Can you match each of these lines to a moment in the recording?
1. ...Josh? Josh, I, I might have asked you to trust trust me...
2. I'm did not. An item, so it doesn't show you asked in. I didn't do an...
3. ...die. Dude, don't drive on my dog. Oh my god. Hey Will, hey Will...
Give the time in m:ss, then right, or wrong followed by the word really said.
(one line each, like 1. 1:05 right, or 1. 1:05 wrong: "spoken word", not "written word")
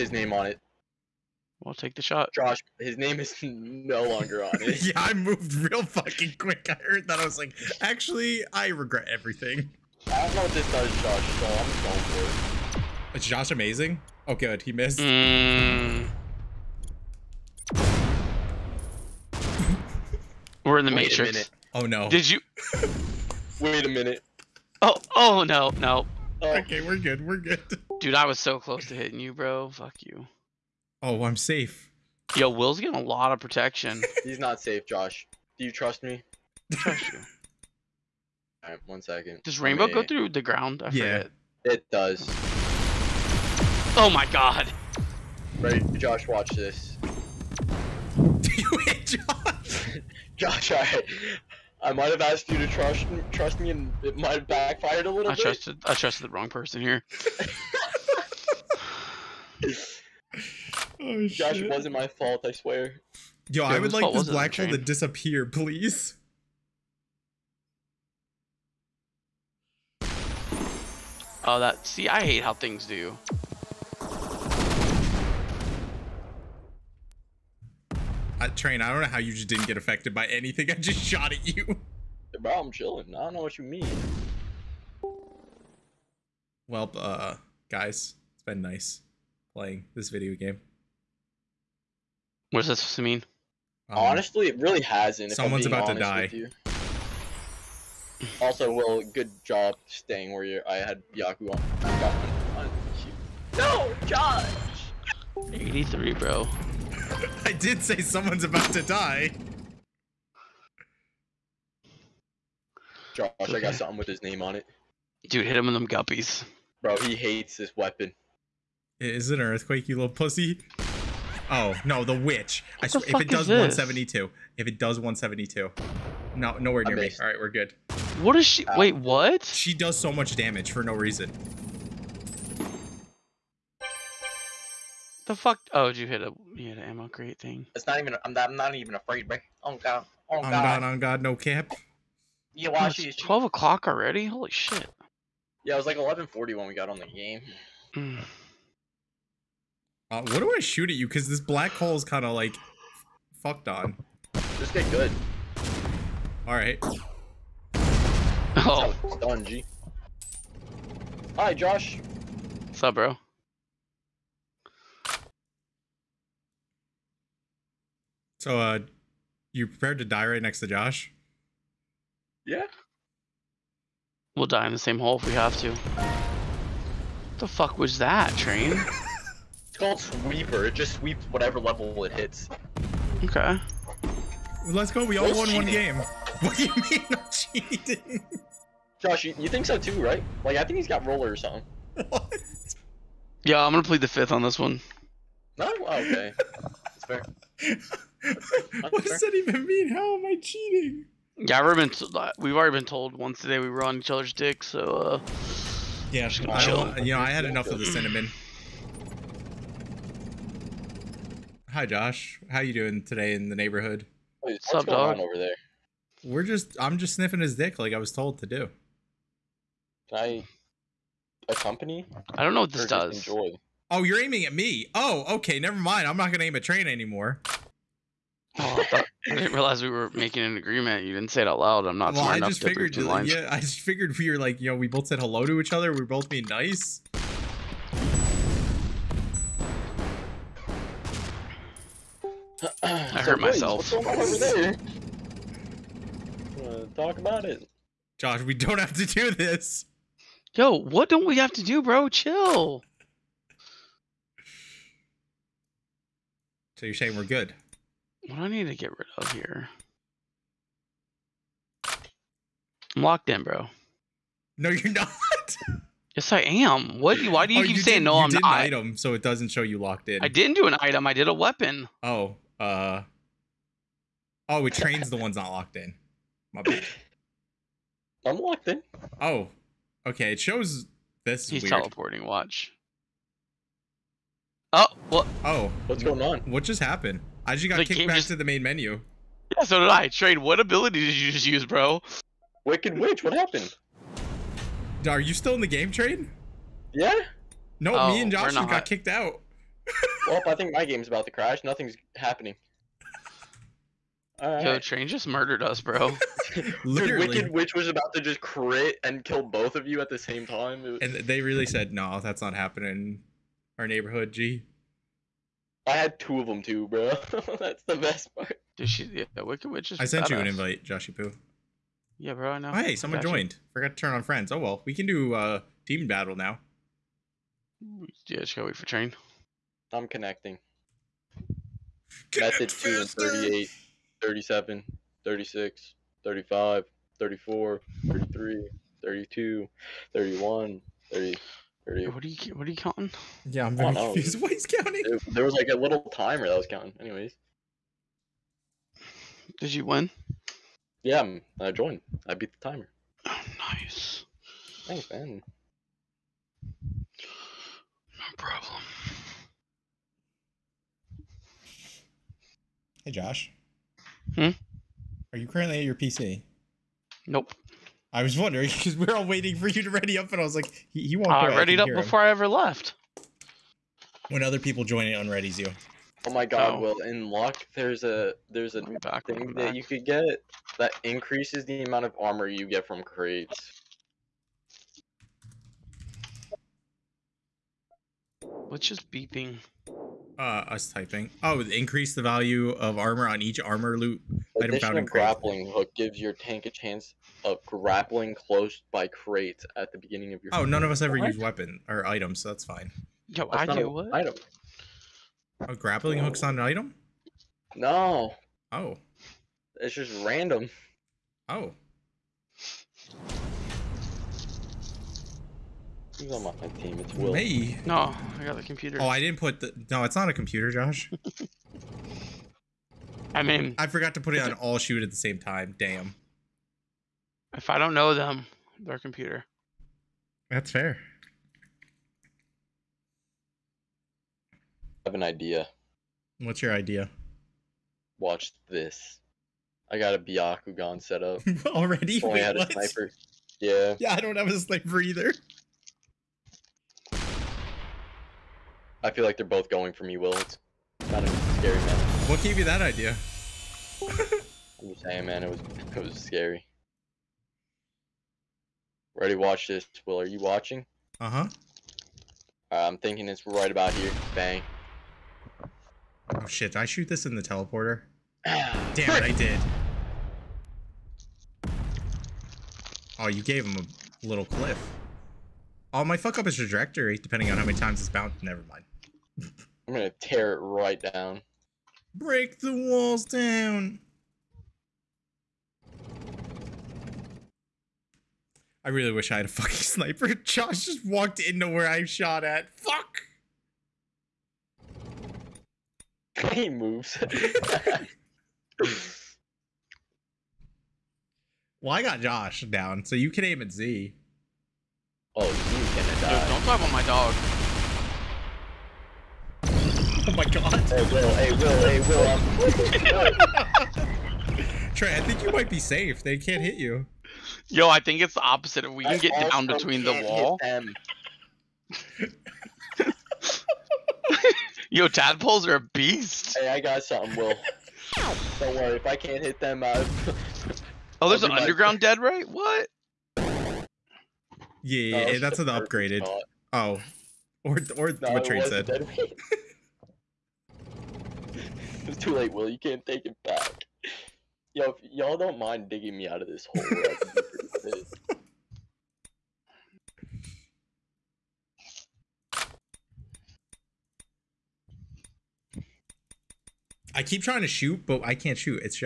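1. 0:49 right
2. 4:28 wrong: "locked", not "asked"
3. 8:26 right.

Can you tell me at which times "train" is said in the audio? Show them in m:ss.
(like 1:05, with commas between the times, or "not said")
1:18, 2:58, 3:46, 4:34, 4:50, 4:55, 5:04, 5:28.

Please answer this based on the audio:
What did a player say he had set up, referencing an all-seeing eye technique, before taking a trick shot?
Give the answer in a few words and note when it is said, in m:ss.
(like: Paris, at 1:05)
Byakugan, at 7:20.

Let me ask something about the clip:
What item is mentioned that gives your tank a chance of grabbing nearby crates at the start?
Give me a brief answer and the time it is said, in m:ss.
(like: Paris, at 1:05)
grappling hook, at 6:35.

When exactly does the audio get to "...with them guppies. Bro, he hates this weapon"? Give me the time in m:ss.
1:55.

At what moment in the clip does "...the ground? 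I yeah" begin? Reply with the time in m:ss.
0:40.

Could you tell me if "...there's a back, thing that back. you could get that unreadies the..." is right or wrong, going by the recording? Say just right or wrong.
wrong.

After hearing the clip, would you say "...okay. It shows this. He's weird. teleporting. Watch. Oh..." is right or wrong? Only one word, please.
right.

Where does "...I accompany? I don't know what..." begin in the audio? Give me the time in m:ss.
3:40.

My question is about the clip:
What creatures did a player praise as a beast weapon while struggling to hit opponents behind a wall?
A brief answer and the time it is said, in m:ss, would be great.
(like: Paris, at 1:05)
tadpoles, at 8:45.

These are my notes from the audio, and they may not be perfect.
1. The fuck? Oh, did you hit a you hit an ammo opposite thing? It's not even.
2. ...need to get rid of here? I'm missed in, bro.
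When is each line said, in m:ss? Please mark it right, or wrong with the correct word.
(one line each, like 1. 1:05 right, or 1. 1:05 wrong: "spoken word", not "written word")
1. 2:15 wrong: "crate", not "opposite"
2. 4:18 wrong: "locked", not "missed".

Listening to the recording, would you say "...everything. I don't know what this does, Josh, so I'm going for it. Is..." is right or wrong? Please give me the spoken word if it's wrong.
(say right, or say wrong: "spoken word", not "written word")
right.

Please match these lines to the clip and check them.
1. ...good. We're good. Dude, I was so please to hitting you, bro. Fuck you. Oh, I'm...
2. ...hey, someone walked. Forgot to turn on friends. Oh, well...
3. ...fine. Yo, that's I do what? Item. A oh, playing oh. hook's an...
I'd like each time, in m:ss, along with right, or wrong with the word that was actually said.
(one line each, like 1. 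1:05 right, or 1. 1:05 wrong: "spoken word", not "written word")
1. 0:26 wrong: "close", not "please"
2. 5:22 wrong: "joined", not "walked"
3. 6:42 wrong: "grappling", not "playing".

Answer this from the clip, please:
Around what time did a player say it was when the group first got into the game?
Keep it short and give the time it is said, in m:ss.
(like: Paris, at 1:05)
11:40, at 2:25.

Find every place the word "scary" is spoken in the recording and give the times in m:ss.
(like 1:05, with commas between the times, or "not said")
7:31, 7:36.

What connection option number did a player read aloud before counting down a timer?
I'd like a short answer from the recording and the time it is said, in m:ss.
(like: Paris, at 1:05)
2, at 5:32.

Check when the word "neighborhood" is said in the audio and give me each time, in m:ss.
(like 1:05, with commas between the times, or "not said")
3:33, 5:13.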